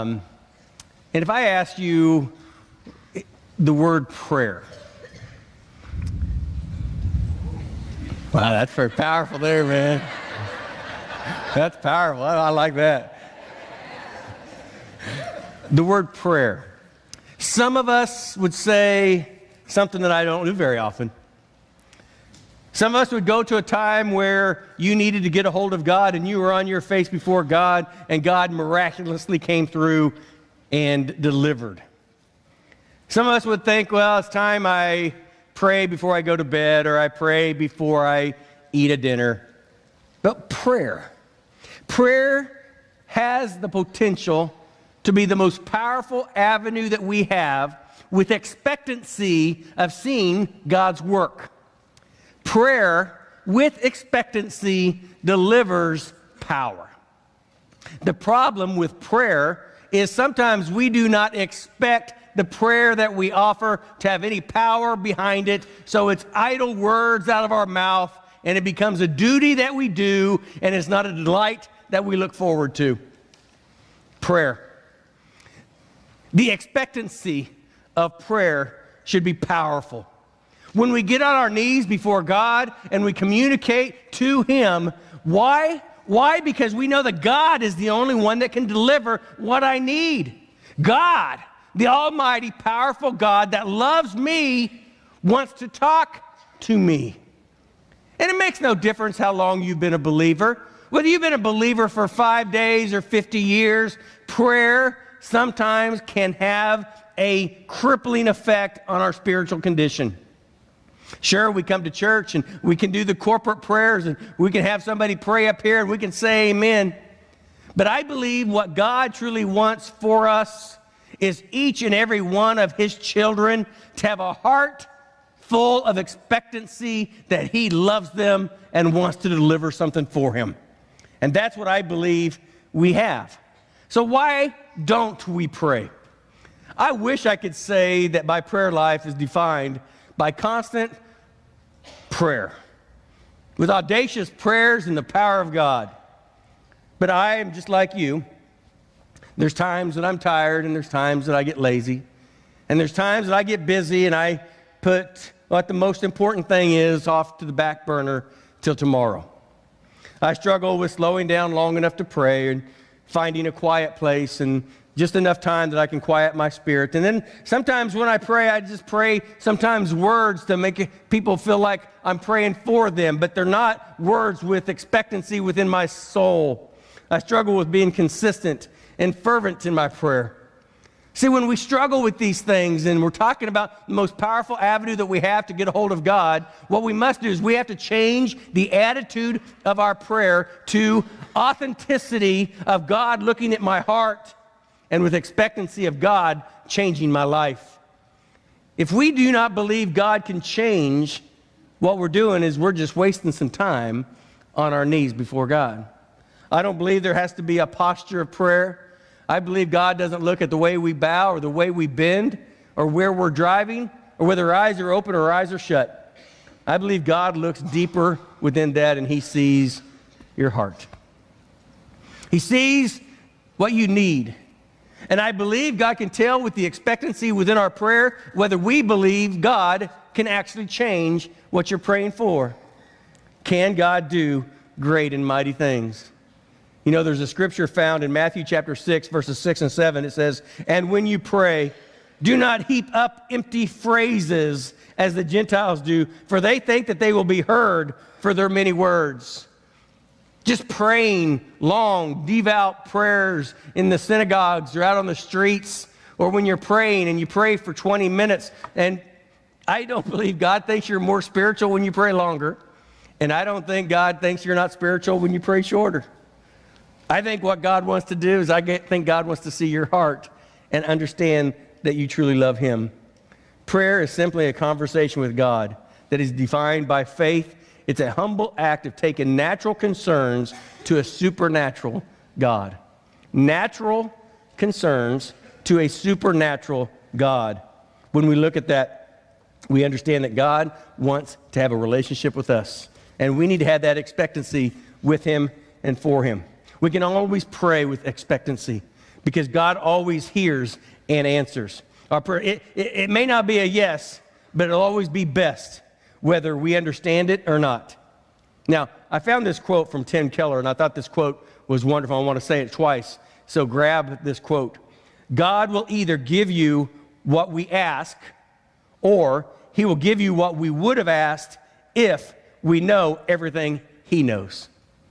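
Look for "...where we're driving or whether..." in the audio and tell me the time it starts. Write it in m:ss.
3:32.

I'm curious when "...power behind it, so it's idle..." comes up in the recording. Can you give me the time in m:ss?
1:04.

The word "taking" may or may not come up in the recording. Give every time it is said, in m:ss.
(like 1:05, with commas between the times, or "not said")
4:38.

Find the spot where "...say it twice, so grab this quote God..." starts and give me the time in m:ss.
5:12.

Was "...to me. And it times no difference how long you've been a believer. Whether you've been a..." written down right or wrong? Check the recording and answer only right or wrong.
wrong.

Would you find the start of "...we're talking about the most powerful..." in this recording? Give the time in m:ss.
3:03.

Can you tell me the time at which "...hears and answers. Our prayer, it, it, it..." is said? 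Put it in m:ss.
5:00.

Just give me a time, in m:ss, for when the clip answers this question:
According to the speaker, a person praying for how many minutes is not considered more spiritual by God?
4:17.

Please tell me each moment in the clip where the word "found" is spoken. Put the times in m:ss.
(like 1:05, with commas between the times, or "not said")
3:57, 5:09.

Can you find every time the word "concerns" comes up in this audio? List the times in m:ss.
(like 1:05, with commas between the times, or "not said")
4:39, 4:44.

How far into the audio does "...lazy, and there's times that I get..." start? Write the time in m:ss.
2:31.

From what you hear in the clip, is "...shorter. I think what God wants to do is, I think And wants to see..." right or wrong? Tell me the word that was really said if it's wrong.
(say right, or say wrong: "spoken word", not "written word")
wrong: "God", not "And".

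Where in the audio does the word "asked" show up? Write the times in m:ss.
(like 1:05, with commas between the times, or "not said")
0:01, 5:21.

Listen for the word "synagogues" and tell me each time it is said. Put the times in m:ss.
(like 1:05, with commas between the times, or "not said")
4:13.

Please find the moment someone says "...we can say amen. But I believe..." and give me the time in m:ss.
1:55.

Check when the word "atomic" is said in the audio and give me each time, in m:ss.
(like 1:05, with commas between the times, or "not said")
not said.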